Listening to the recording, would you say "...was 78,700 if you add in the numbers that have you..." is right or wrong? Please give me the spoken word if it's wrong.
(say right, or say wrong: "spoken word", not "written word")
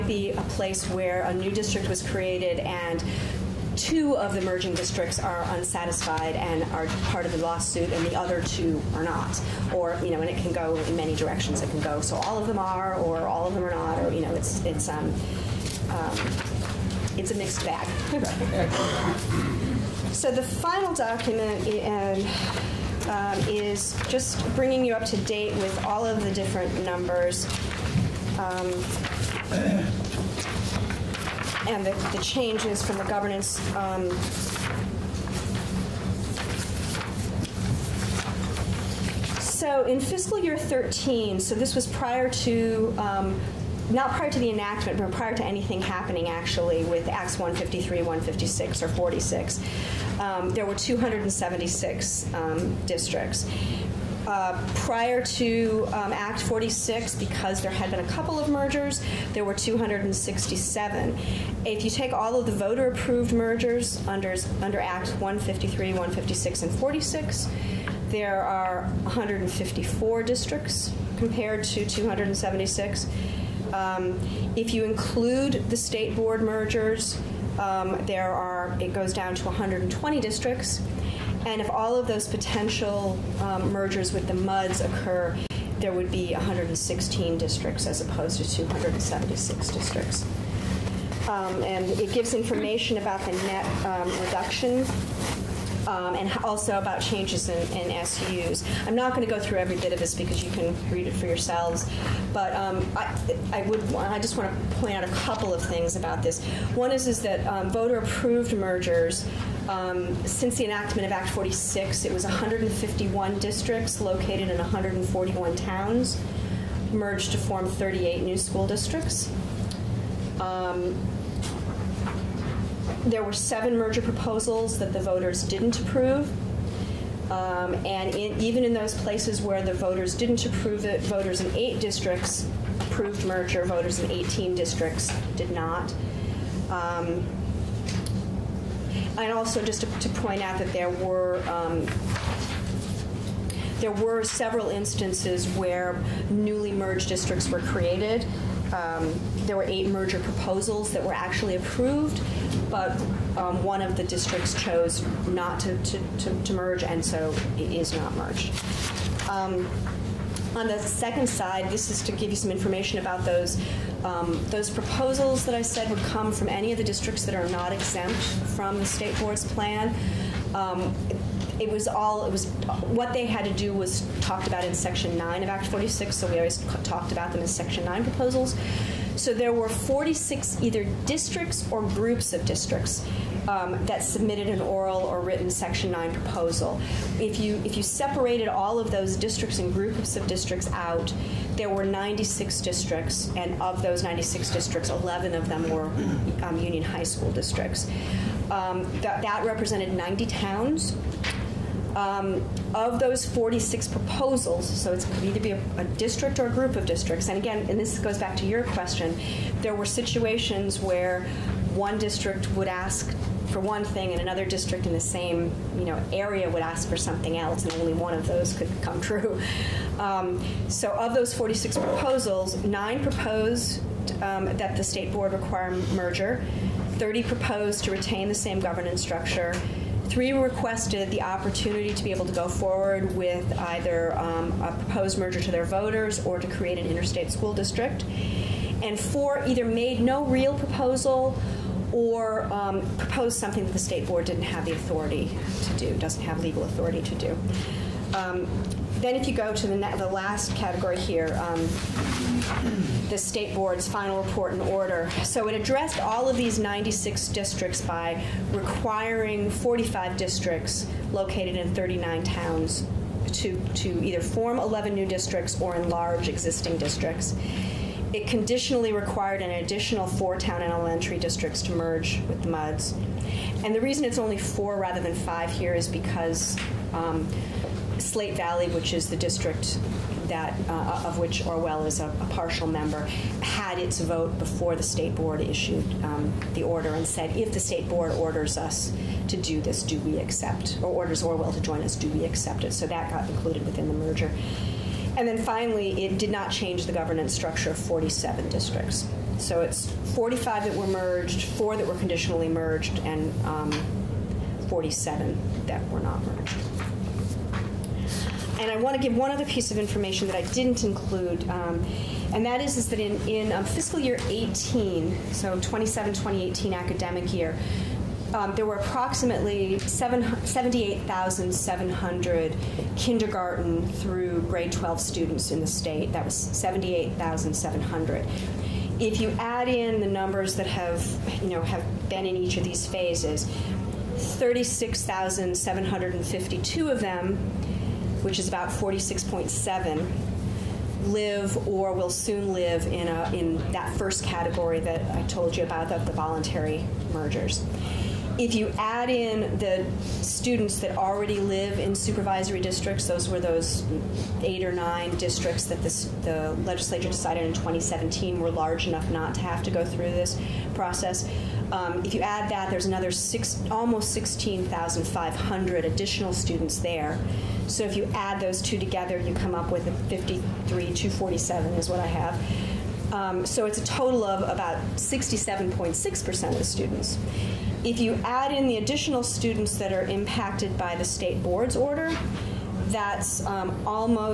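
right.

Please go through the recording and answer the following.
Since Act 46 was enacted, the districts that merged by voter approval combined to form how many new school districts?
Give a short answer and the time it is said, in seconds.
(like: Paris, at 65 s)
38, at 117 s.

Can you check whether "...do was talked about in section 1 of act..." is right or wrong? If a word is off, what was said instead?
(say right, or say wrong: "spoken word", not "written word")
wrong: "9", not "1".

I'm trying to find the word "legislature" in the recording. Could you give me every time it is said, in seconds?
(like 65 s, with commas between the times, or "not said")
356 s.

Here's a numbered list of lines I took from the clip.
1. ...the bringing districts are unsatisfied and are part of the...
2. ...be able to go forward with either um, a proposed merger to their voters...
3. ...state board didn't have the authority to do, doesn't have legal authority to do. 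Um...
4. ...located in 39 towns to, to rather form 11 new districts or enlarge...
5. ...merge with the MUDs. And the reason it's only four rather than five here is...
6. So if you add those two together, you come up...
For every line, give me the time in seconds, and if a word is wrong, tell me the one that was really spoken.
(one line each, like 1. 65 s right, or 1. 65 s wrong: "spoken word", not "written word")
1. 4 s wrong: "merging", not "bringing"
2. 232 s right
3. 243 s right
4. 261 s wrong: "either", not "rather"
5. 271 s right
6. 367 s right.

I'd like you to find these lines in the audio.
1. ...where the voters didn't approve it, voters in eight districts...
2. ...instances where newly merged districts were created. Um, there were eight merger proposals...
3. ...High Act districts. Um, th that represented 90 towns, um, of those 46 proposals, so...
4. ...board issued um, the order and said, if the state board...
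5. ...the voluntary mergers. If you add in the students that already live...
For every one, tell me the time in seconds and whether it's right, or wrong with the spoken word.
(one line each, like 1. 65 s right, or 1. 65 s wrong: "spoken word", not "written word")
1. 129 s right
2. 144 s right
3. 196 s wrong: "School", not "Act"
4. 285 s right
5. 345 s right.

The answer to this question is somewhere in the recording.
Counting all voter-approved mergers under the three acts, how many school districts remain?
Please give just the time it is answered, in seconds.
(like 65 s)
69 s.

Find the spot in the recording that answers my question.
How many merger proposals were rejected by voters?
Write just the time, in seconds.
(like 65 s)
123 s.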